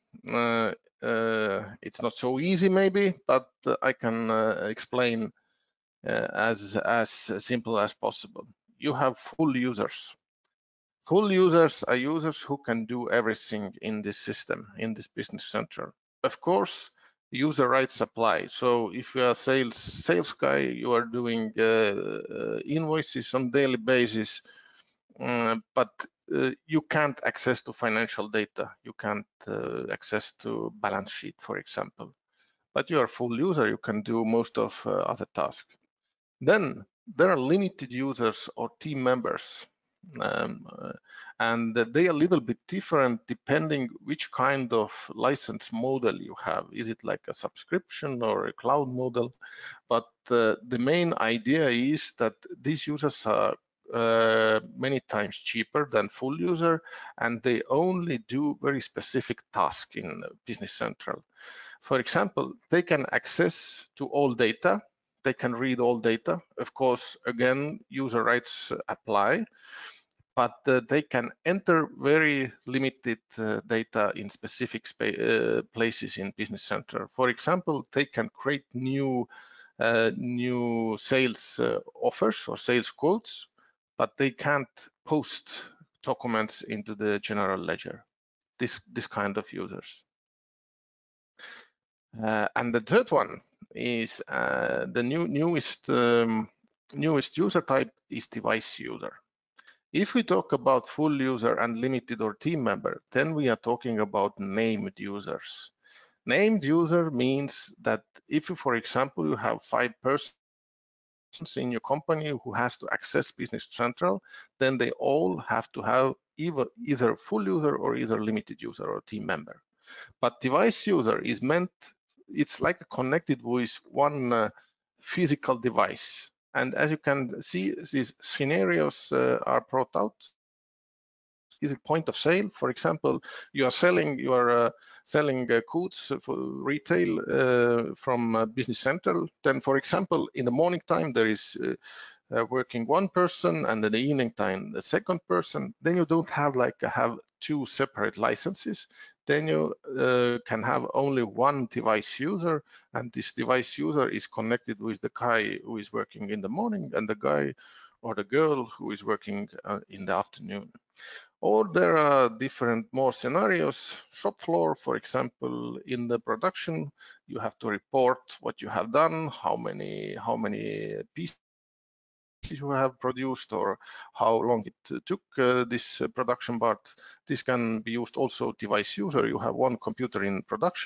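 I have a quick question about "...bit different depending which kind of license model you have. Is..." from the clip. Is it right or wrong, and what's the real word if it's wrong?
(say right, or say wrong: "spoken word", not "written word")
right.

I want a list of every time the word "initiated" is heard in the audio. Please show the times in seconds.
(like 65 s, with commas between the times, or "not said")
not said.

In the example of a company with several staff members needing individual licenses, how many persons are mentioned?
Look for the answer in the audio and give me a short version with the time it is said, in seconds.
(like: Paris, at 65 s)
5, at 109 s.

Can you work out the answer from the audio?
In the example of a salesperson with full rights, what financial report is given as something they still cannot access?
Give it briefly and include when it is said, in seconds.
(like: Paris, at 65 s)
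Balance sheet, at 30 s.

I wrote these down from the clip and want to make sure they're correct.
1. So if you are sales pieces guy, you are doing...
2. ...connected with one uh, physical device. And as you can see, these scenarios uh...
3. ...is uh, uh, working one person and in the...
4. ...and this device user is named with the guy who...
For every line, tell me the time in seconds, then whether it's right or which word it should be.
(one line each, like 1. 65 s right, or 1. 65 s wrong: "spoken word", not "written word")
1. 18 s wrong: "sales", not "pieces"
2. 122 s right
3. 141 s right
4. 152 s wrong: "connected", not "named".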